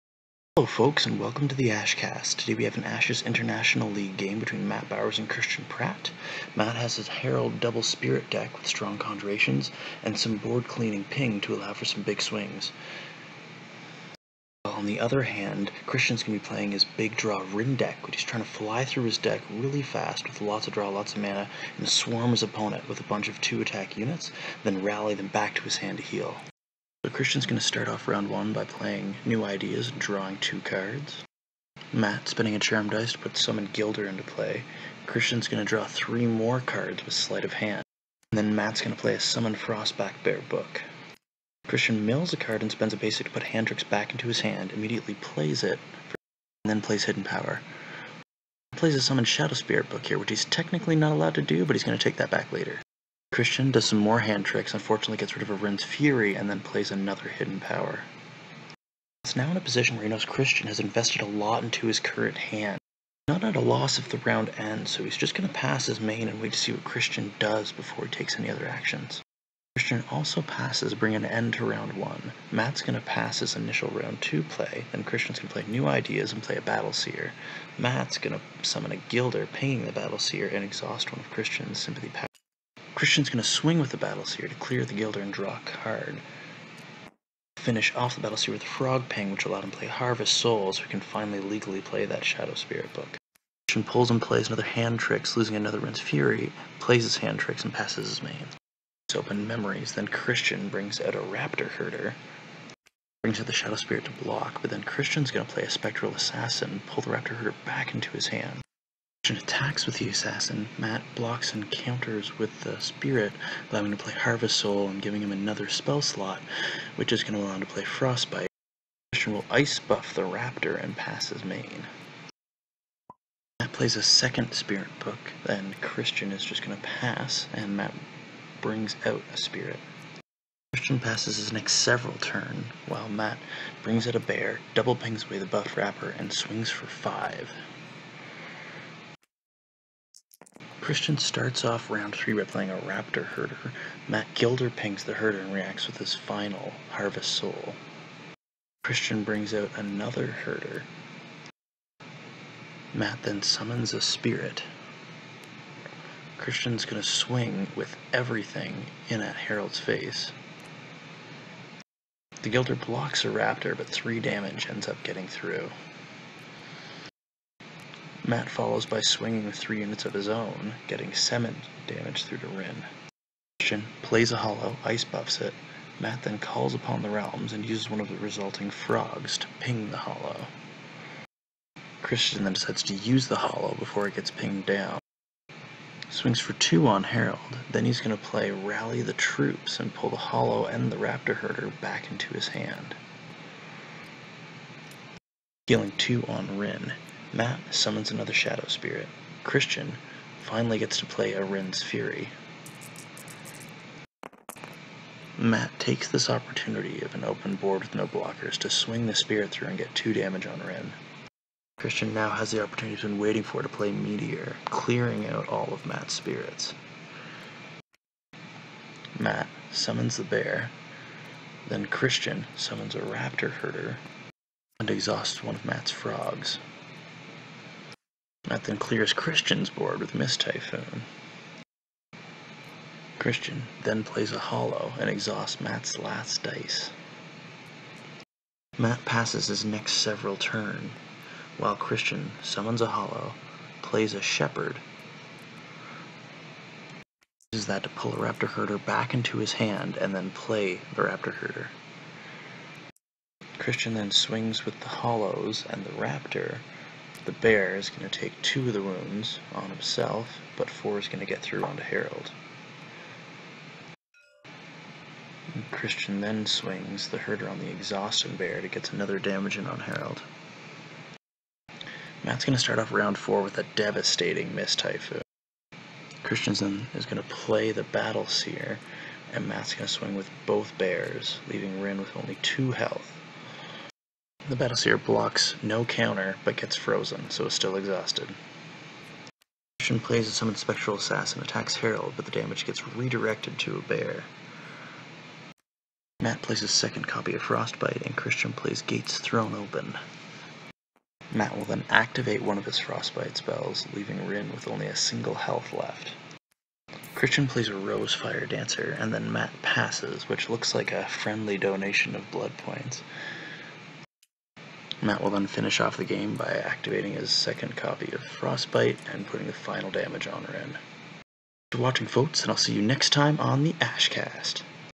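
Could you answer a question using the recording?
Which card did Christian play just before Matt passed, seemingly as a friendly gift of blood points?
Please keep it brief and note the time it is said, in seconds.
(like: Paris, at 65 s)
Rose Fire Dancer, at 307 s.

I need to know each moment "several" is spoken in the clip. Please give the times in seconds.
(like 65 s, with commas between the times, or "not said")
131 s, 239 s.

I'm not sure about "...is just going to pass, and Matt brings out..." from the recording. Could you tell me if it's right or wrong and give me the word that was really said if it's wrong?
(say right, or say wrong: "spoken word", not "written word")
right.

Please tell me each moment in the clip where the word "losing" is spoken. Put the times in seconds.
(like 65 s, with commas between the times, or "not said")
95 s.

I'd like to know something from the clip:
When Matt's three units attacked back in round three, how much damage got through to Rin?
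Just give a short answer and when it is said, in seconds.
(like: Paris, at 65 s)
7, at 171 s.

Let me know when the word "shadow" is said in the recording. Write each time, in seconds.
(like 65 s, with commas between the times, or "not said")
49 s, 92 s, 103 s, 198 s.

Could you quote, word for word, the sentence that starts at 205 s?
Matt takes this opportunity of an open board with no blockers to swing the spirit through and get 2 damage on Rin.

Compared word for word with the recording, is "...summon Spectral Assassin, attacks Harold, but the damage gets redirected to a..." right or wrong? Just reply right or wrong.
right.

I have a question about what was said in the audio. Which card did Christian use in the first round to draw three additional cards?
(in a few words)
Sleight of Hand.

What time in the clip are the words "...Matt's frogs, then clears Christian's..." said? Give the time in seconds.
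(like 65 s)
225 s.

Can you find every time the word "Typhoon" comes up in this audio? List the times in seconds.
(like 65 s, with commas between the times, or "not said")
230 s, 274 s.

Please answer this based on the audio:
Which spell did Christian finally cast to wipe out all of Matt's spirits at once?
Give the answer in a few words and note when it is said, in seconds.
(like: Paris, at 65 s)
Meteor, at 213 s.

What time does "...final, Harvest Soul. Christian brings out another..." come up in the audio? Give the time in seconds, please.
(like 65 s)
146 s.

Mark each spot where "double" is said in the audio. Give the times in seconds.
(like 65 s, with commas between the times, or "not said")
7 s, 134 s.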